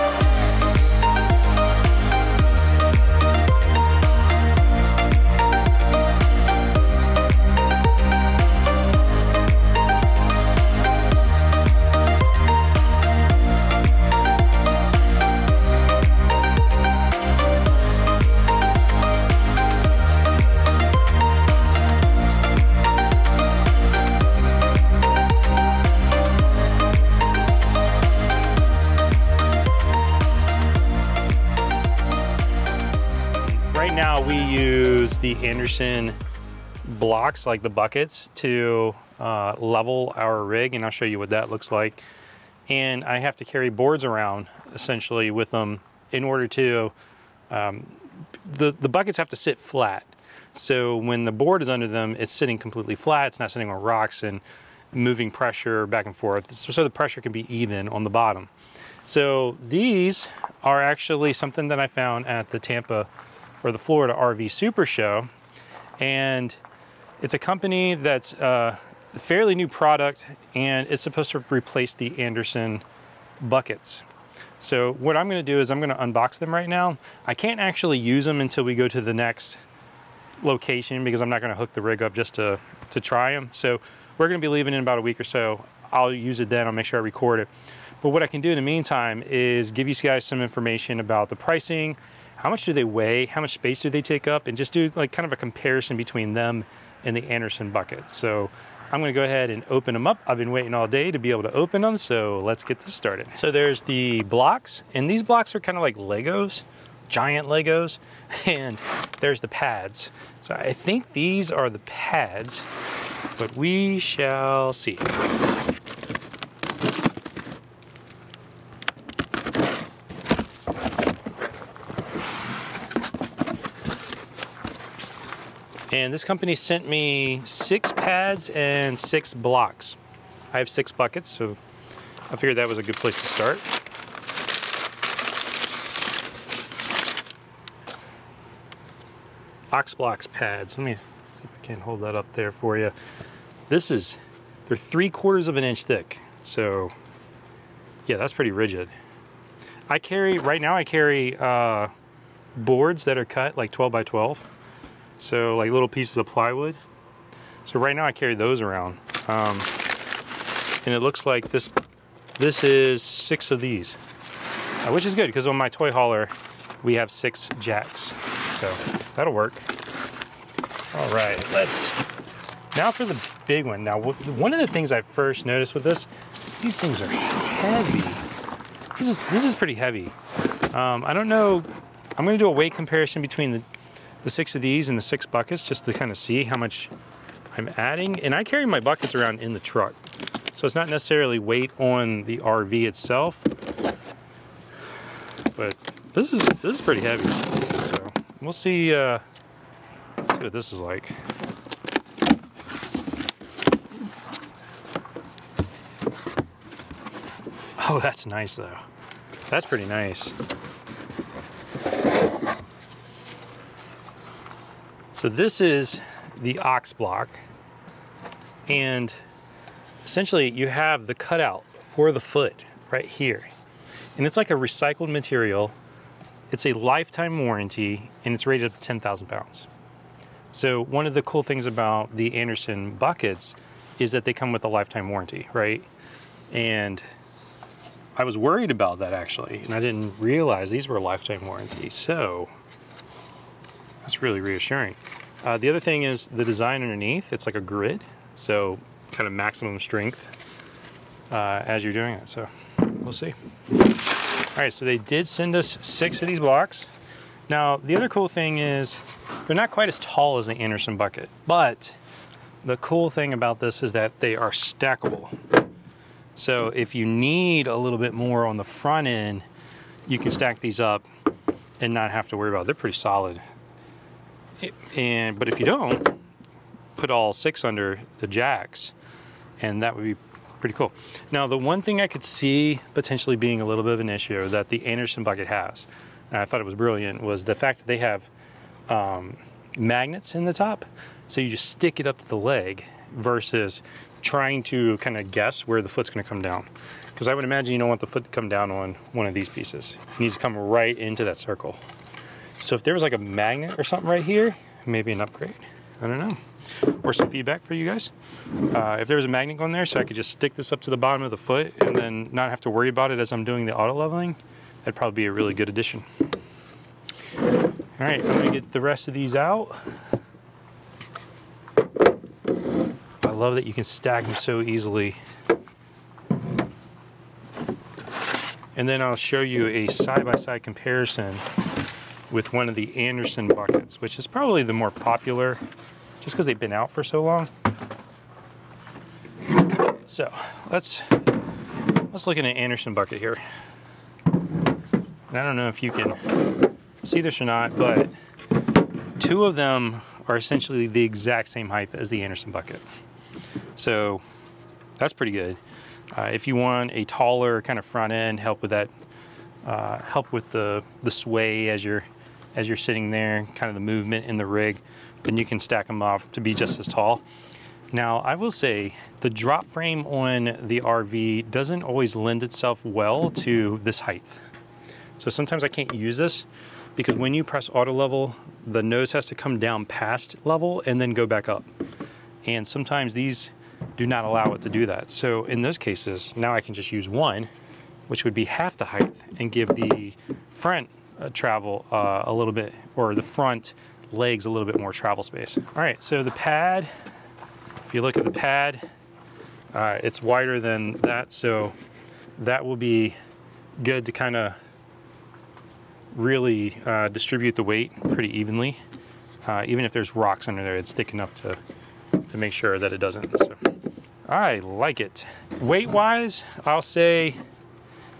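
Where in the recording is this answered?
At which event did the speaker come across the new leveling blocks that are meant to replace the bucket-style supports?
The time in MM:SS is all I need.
01:03.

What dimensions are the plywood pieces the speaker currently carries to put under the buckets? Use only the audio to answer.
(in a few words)
12 by 12.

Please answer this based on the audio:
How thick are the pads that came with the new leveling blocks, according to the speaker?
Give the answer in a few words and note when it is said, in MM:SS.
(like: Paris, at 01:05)
3/4 inch, at 02:24.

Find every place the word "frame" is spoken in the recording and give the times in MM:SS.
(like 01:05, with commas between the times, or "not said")
06:09.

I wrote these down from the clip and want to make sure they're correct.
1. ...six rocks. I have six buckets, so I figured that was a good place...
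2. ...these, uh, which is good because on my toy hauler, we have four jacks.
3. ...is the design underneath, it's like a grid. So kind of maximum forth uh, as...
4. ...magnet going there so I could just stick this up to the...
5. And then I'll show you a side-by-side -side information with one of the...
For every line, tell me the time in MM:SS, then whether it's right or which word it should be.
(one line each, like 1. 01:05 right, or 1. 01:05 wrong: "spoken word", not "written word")
1. 02:08 wrong: "blocks", not "rocks"
2. 02:43 wrong: "six", not "four"
3. 04:06 wrong: "strength", not "forth"
4. 05:09 right
5. 05:28 wrong: "comparison", not "information".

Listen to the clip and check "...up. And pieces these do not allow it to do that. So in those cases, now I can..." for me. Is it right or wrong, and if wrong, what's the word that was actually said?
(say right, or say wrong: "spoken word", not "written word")
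wrong: "sometimes", not "pieces".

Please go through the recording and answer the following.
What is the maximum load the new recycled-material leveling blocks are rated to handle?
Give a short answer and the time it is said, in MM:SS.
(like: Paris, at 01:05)
10,000 pounds, at 03:48.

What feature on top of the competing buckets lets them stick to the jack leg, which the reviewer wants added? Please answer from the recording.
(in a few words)
Magnets.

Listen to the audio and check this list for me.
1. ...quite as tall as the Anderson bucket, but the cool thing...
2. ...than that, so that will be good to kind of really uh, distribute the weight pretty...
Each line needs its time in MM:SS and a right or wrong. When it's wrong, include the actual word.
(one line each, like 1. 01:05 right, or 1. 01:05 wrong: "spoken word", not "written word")
1. 04:19 right
2. 06:40 right.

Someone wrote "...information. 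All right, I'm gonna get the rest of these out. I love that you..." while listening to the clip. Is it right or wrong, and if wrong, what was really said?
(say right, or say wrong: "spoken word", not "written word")
wrong: "addition", not "information".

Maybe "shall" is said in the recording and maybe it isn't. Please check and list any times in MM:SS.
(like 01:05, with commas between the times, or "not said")
01:53.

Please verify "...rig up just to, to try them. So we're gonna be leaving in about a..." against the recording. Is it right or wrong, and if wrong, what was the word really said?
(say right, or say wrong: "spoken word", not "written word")
right.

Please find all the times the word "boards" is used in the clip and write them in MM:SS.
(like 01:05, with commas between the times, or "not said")
00:43, 00:51, 02:32.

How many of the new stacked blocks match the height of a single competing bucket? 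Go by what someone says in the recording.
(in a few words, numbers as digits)
2.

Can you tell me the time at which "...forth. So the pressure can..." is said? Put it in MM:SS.
00:56.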